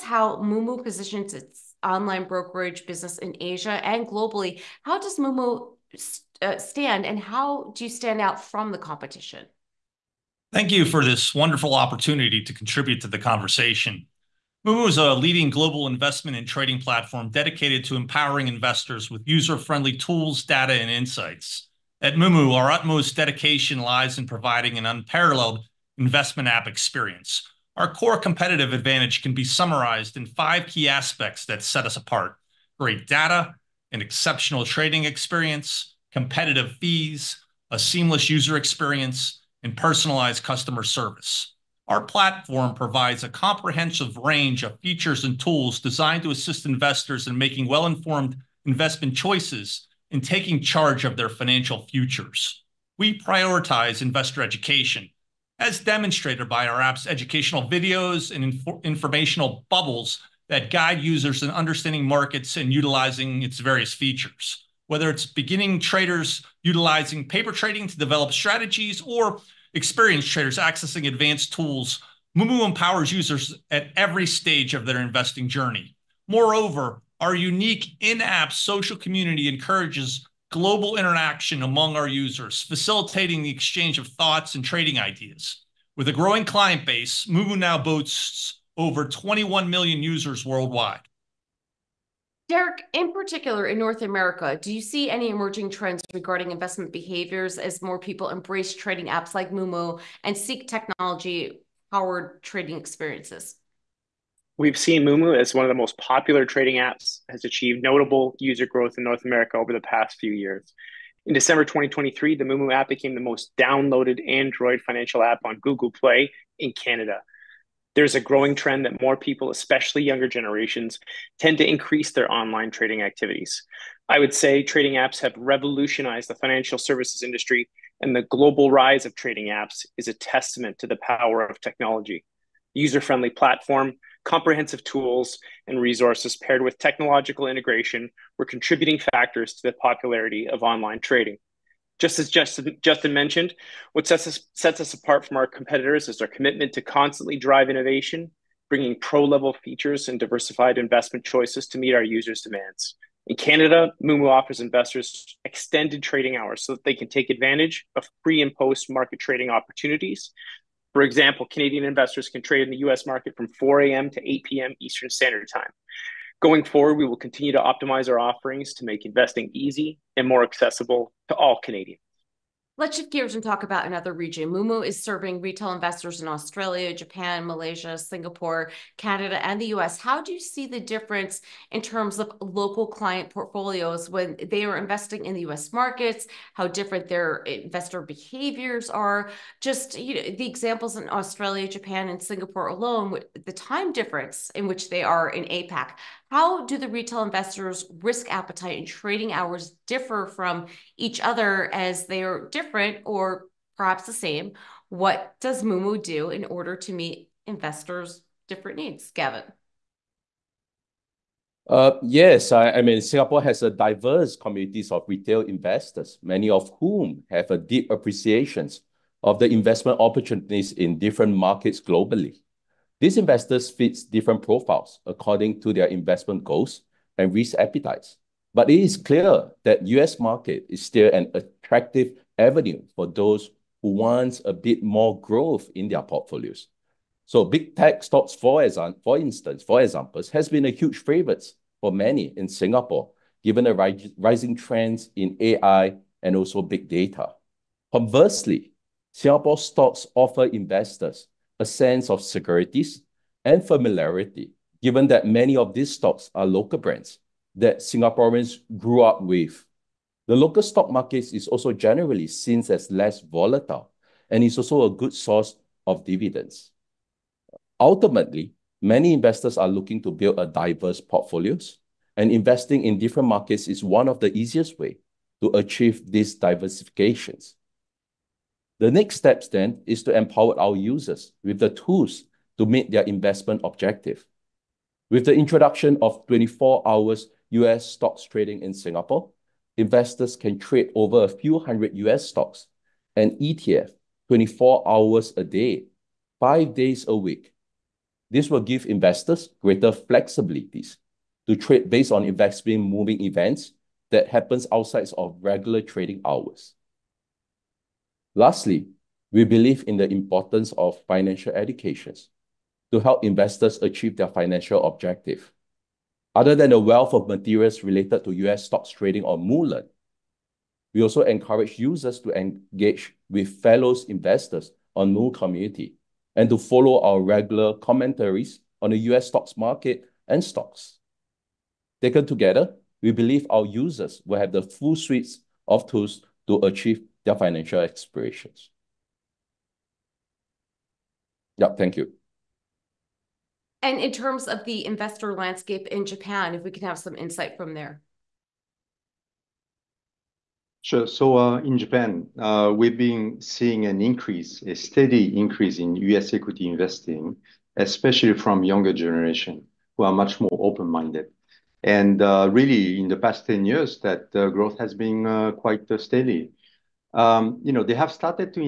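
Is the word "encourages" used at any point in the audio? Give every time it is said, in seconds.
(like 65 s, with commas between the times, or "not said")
79 s, 321 s.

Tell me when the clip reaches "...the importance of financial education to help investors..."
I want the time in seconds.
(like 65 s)
309 s.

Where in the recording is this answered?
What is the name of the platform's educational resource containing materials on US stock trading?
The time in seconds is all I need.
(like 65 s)
319 s.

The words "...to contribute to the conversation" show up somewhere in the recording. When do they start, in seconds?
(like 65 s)
12 s.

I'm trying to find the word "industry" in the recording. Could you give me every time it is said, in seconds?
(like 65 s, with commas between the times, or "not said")
127 s.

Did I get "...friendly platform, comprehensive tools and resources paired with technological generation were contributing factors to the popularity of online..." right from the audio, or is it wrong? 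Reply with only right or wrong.
wrong.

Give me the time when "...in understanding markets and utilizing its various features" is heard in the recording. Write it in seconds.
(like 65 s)
61 s.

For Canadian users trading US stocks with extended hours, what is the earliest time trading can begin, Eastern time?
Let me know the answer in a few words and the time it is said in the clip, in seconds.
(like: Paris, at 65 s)
4 a.m., at 163 s.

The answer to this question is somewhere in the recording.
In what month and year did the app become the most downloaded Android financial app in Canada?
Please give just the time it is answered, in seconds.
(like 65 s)
111 s.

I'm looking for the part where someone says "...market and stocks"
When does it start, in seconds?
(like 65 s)
329 s.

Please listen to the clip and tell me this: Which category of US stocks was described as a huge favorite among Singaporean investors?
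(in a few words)
Big tech stocks.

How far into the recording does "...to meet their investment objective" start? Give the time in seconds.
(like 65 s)
282 s.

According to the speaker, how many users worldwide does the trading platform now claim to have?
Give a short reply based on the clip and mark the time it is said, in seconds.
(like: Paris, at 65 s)
21 million, at 89 s.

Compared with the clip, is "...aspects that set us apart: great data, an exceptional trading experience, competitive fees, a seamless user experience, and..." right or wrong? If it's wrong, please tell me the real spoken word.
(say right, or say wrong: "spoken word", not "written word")
right.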